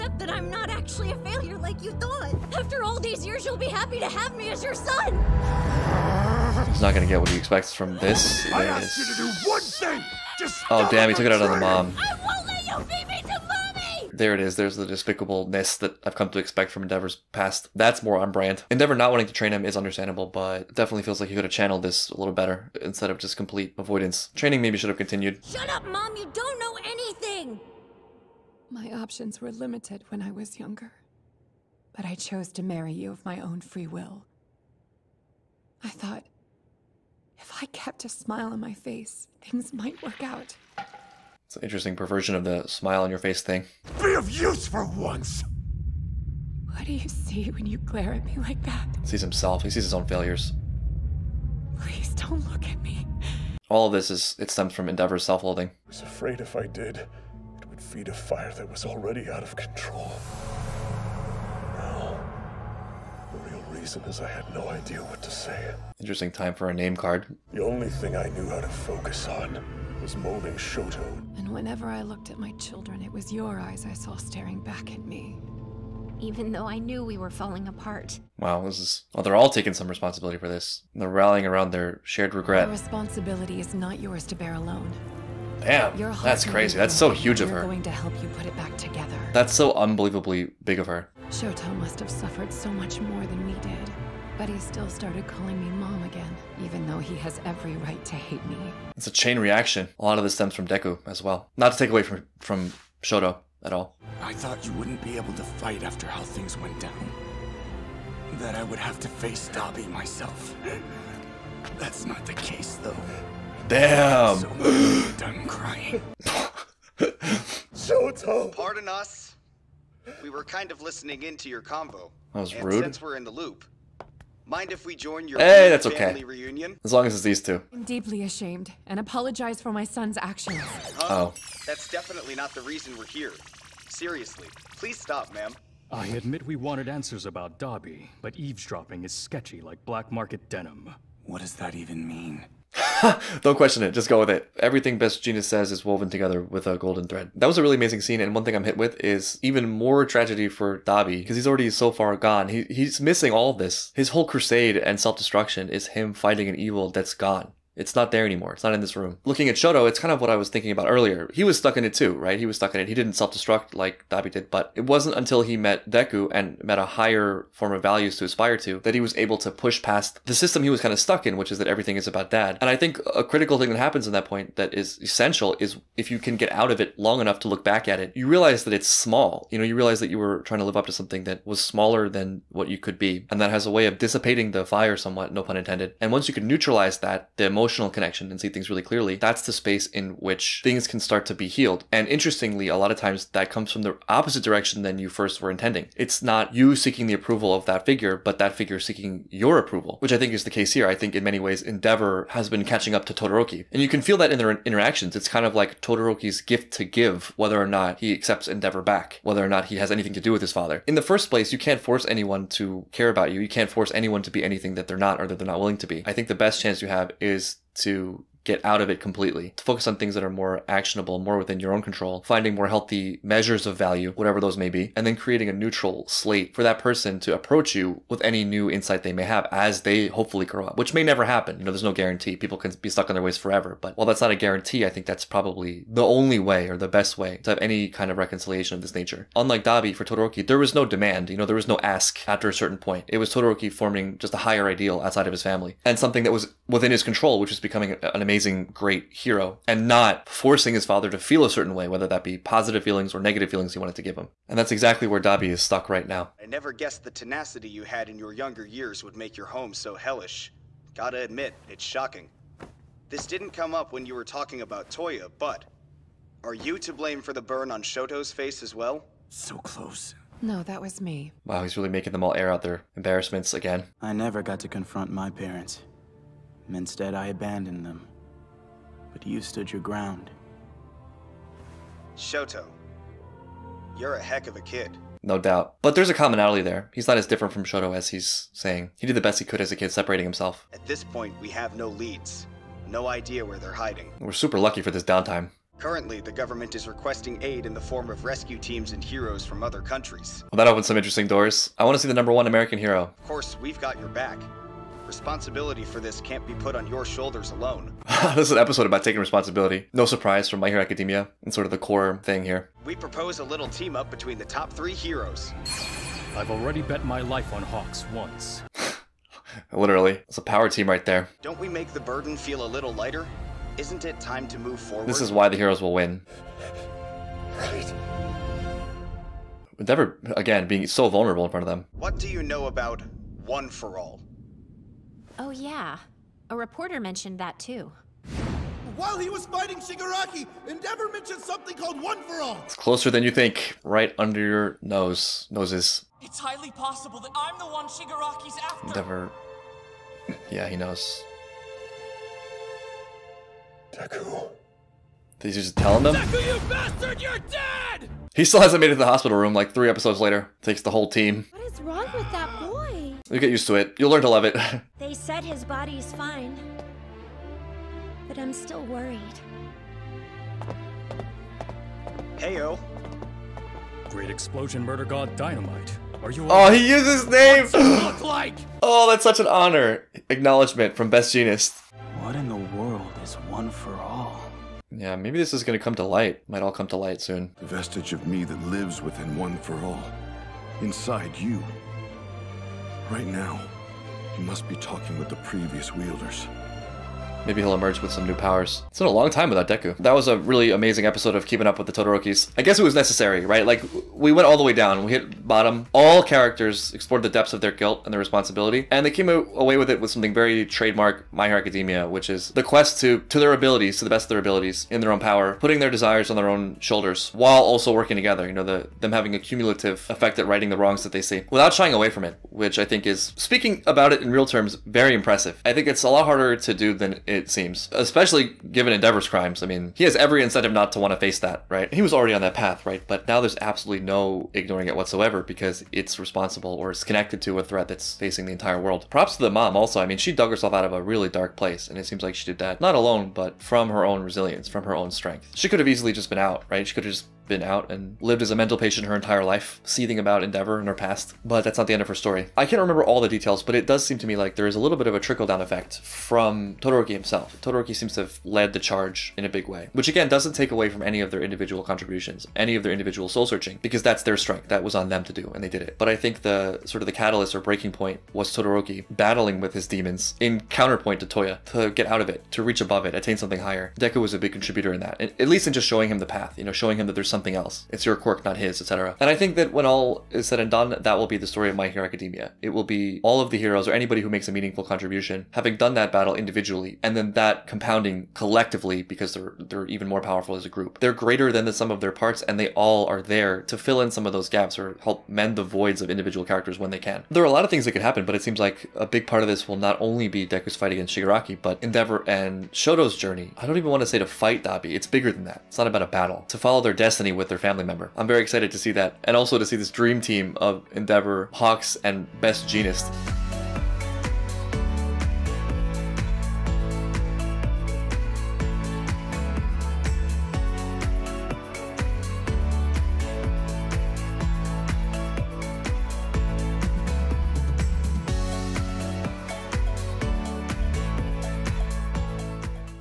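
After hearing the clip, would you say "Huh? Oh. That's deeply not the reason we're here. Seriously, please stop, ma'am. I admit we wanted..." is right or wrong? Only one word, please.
wrong.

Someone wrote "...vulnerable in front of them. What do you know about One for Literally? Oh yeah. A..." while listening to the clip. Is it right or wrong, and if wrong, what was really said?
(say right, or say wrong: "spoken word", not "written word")
wrong: "All", not "Literally".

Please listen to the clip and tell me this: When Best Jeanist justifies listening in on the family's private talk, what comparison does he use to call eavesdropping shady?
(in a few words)
black market denim.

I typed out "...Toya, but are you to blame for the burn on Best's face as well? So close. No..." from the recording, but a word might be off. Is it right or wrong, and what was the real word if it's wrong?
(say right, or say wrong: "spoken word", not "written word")
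wrong: "Shoto", not "Best".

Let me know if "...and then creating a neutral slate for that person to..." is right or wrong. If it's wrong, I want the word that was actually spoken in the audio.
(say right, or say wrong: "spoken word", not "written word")
right.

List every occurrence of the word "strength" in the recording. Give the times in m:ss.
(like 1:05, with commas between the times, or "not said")
7:25, 7:44.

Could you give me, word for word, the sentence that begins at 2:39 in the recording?
Looking at Shoto, it's kind of what I was thinking about earlier.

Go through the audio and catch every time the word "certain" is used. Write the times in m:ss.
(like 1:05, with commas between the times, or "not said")
4:02, 4:11.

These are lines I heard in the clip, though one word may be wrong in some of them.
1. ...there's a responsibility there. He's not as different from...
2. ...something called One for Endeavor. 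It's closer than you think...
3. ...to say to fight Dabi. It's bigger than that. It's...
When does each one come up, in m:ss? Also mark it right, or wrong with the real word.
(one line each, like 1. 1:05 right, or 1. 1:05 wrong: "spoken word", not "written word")
1. 4:45 wrong: "commonality", not "responsibility"
2. 5:41 wrong: "All", not "Endeavor"
3. 8:24 right.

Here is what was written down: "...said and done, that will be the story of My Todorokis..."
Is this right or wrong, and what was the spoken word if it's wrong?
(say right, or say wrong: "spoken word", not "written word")
wrong: "Hero", not "Todorokis".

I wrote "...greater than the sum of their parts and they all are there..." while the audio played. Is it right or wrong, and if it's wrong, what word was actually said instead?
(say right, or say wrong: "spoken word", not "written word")
right.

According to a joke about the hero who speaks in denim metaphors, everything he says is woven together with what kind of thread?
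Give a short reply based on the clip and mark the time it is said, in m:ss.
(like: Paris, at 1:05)
golden thread, at 2:26.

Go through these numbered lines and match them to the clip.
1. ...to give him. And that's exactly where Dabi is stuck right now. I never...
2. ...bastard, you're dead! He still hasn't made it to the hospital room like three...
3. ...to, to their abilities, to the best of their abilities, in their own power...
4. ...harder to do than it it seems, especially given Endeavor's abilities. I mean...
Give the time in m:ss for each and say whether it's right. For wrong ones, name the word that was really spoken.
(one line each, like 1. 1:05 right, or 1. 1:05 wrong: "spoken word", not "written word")
1. 4:13 right
2. 5:56 right
3. 6:52 right
4. 7:06 wrong: "crimes", not "abilities".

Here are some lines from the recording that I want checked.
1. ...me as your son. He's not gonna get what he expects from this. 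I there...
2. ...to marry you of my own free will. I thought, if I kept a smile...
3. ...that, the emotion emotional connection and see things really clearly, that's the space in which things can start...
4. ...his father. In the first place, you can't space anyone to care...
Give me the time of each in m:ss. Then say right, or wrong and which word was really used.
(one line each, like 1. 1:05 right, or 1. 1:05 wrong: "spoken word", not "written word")
1. 0:04 right
2. 0:32 right
3. 3:06 right
4. 3:30 wrong: "force", not "space".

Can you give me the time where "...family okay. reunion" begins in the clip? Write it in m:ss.
2:05.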